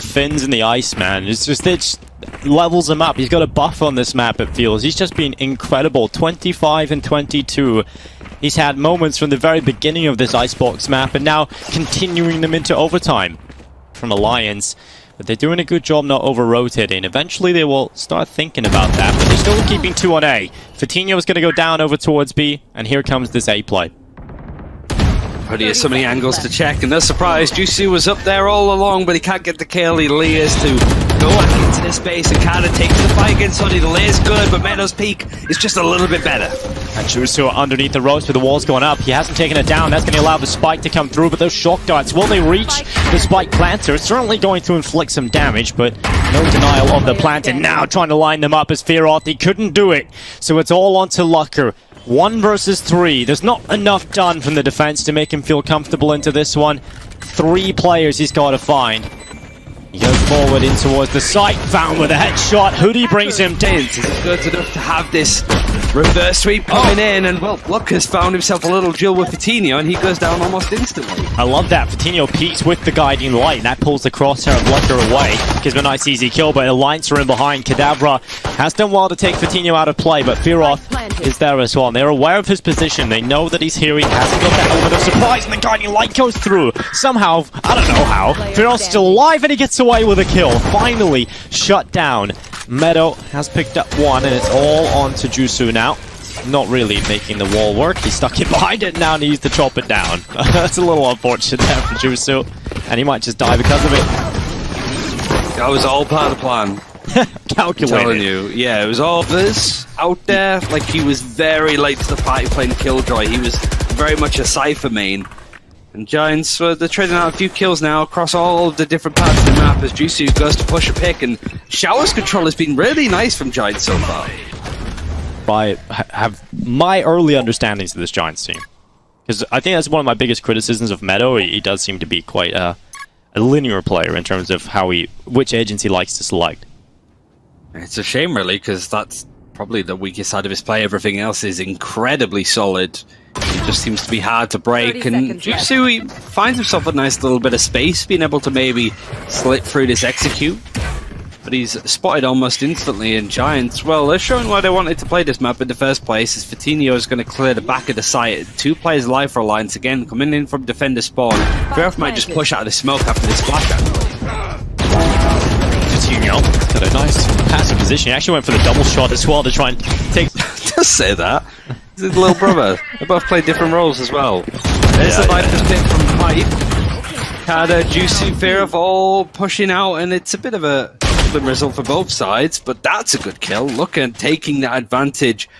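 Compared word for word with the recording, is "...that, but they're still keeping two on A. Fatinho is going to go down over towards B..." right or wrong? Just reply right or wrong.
right.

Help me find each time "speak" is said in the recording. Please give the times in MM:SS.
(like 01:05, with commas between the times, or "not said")
not said.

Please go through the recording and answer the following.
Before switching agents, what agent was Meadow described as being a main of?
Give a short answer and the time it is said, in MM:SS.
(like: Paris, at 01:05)
Cypher, at 01:54.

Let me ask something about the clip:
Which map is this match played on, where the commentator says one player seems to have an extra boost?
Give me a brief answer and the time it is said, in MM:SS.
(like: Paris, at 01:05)
Icebox, at 00:10.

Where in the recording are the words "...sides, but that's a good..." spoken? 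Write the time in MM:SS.
03:02.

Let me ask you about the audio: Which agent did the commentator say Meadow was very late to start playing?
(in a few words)
Killjoy.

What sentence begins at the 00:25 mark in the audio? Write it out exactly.
But he has so many angles to check, and they're surprised.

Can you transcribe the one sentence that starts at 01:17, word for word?
Kadavra has done well to take Fatinho out of play, but Fearoth is there as well.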